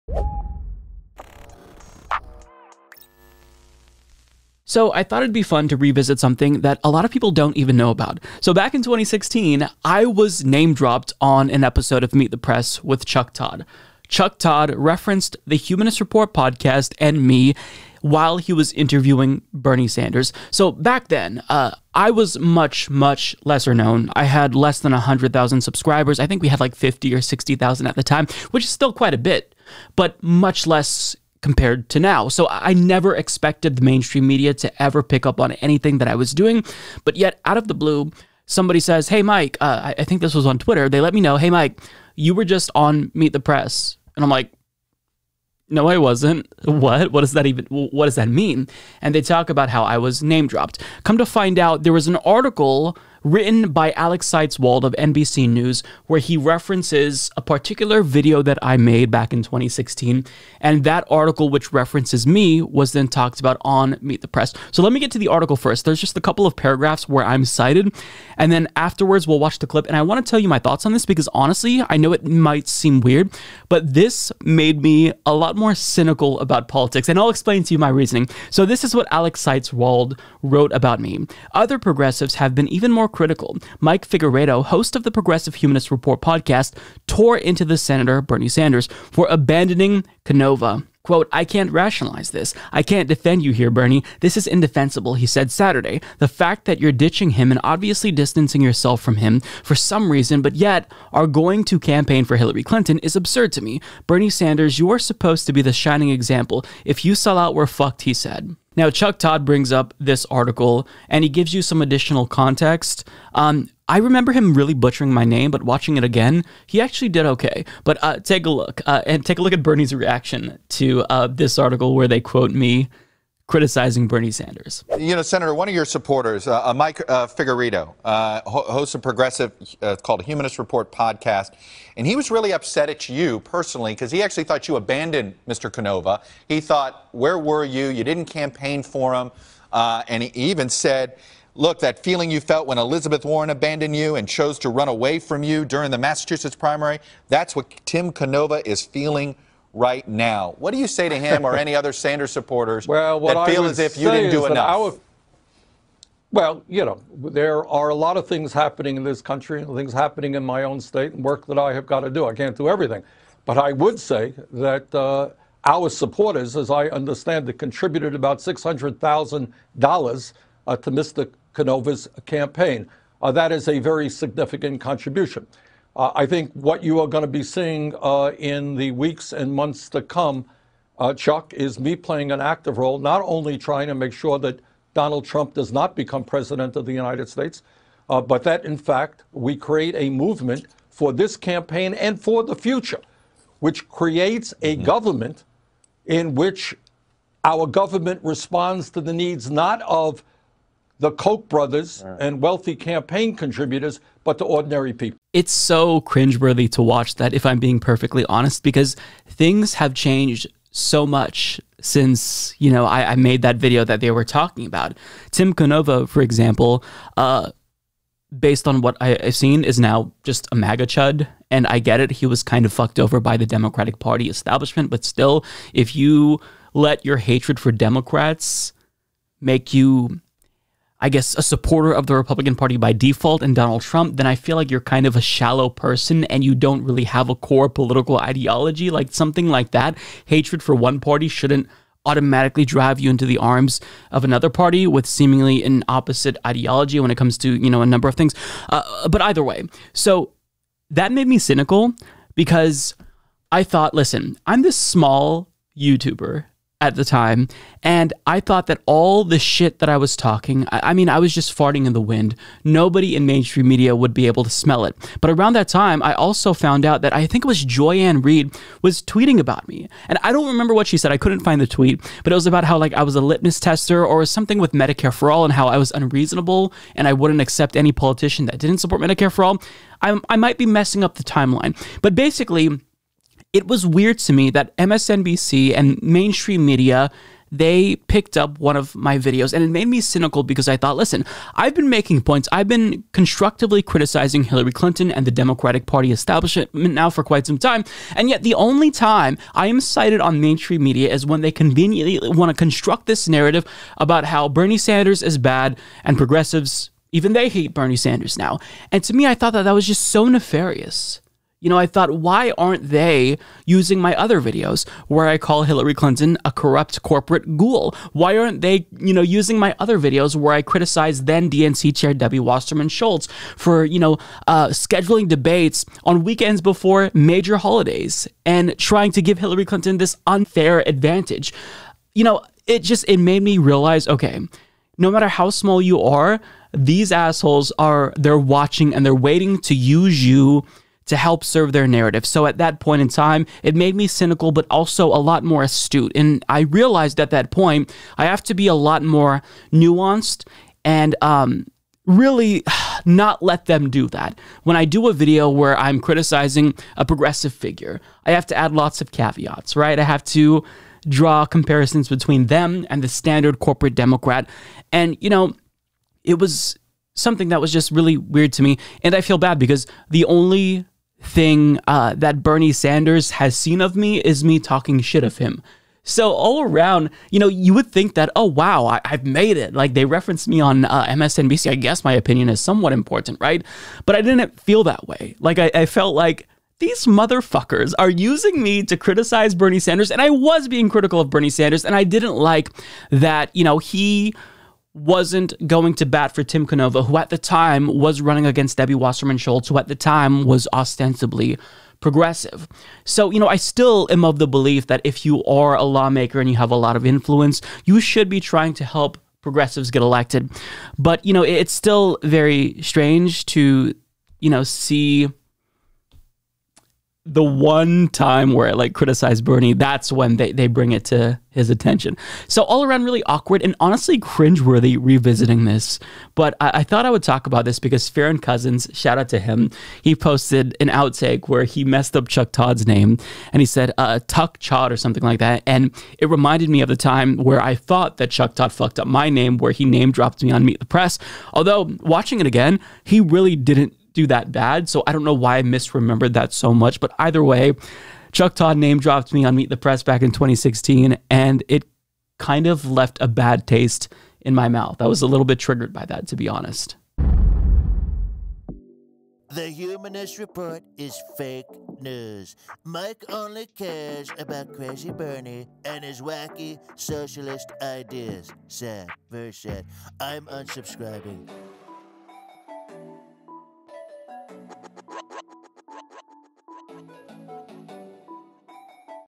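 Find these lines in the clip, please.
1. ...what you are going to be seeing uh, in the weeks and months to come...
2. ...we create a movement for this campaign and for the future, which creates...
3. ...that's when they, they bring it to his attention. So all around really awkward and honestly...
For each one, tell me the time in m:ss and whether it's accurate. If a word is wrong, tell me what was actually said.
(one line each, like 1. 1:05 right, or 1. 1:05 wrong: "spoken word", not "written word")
1. 2:56 right
2. 3:09 right
3. 6:59 right.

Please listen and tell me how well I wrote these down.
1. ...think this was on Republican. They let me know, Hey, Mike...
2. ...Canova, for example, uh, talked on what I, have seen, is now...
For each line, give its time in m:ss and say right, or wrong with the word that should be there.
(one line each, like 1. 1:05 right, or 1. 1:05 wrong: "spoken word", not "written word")
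1. 0:40 wrong: "Twitter", not "Republican"
2. 3:35 wrong: "based", not "talked".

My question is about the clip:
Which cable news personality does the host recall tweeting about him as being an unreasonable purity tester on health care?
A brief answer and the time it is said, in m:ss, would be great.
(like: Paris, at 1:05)
Joy-Ann Reid, at 4:27.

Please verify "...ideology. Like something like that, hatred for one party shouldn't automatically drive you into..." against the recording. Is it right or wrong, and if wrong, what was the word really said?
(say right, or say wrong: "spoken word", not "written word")
right.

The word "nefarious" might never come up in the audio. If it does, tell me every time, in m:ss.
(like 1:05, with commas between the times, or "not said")
5:10.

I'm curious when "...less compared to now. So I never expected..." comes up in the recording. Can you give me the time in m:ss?
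0:30.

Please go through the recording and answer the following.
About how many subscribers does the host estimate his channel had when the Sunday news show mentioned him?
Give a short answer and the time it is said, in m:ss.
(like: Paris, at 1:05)
50,000 to 60,000, at 0:26.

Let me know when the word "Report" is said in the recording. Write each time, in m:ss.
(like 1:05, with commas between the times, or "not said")
0:15, 1:25, 2:10, 7:40.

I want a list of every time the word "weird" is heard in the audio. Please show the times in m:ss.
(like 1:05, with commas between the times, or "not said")
1:13, 4:43, 6:08.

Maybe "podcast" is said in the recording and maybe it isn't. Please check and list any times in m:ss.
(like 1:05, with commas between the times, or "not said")
0:16, 1:26, 2:10.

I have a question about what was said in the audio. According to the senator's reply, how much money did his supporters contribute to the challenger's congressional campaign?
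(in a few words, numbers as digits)
$600,000.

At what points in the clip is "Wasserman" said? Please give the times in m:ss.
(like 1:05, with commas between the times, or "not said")
5:22, 6:38.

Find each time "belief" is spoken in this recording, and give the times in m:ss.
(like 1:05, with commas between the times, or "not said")
6:44.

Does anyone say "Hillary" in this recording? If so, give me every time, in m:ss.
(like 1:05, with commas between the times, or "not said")
1:42, 4:54, 5:15, 5:29.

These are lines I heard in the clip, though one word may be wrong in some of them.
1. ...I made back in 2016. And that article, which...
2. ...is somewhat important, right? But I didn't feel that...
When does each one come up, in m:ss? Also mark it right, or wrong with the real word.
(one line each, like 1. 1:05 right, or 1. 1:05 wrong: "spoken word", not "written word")
1. 0:58 right
2. 6:22 right.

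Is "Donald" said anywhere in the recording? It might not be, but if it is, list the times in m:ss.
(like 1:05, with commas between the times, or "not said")
3:04, 3:53.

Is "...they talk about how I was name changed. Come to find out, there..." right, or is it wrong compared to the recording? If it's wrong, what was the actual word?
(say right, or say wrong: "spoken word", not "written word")
wrong: "dropped", not "changed".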